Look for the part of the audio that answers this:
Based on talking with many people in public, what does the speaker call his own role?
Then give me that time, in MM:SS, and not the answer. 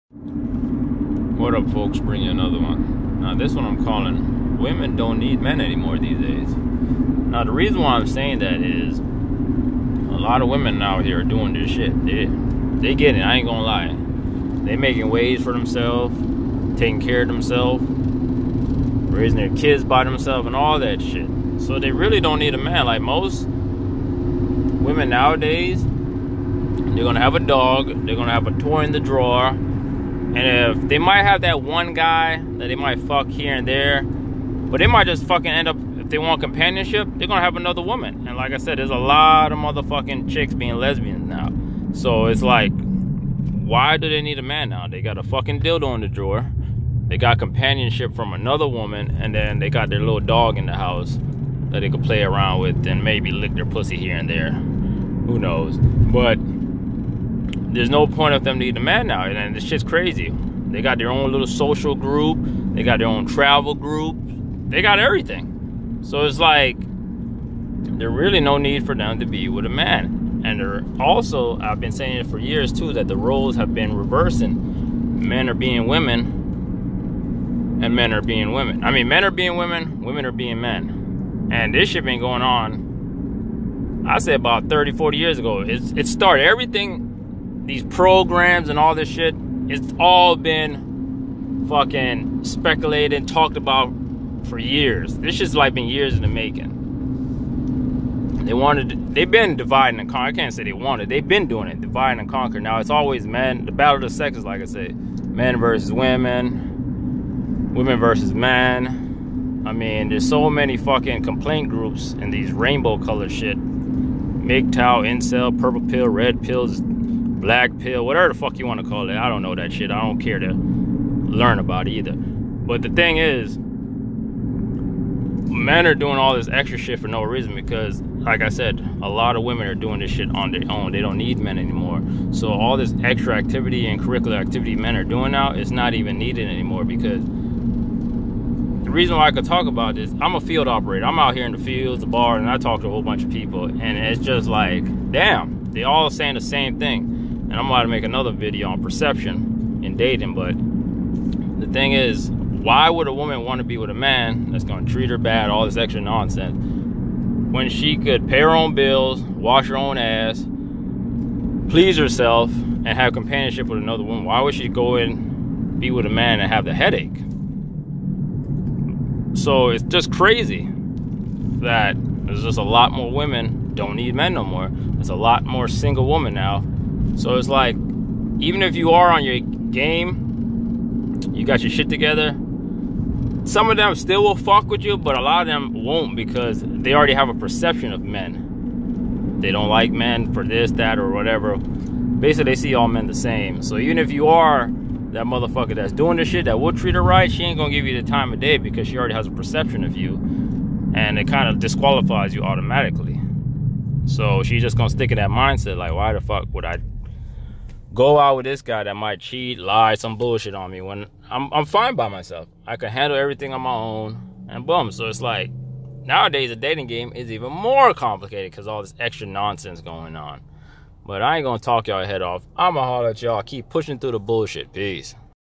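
02:20.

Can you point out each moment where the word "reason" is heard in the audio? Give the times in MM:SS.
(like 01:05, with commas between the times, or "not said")
00:07, 02:07, 02:18.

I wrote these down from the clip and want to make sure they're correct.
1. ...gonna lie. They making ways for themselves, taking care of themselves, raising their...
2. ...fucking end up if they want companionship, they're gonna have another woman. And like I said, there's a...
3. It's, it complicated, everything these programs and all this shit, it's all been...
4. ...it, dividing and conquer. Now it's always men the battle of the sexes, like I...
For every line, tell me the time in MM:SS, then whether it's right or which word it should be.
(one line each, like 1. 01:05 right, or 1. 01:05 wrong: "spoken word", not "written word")
1. 00:13 right
2. 00:35 right
3. 01:25 wrong: "started", not "complicated"
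4. 01:41 right.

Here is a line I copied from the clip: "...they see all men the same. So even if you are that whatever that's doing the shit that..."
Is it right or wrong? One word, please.
wrong.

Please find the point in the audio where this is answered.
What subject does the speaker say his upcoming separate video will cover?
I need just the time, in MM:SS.
02:28.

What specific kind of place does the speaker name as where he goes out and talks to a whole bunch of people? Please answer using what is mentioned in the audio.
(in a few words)
The bar.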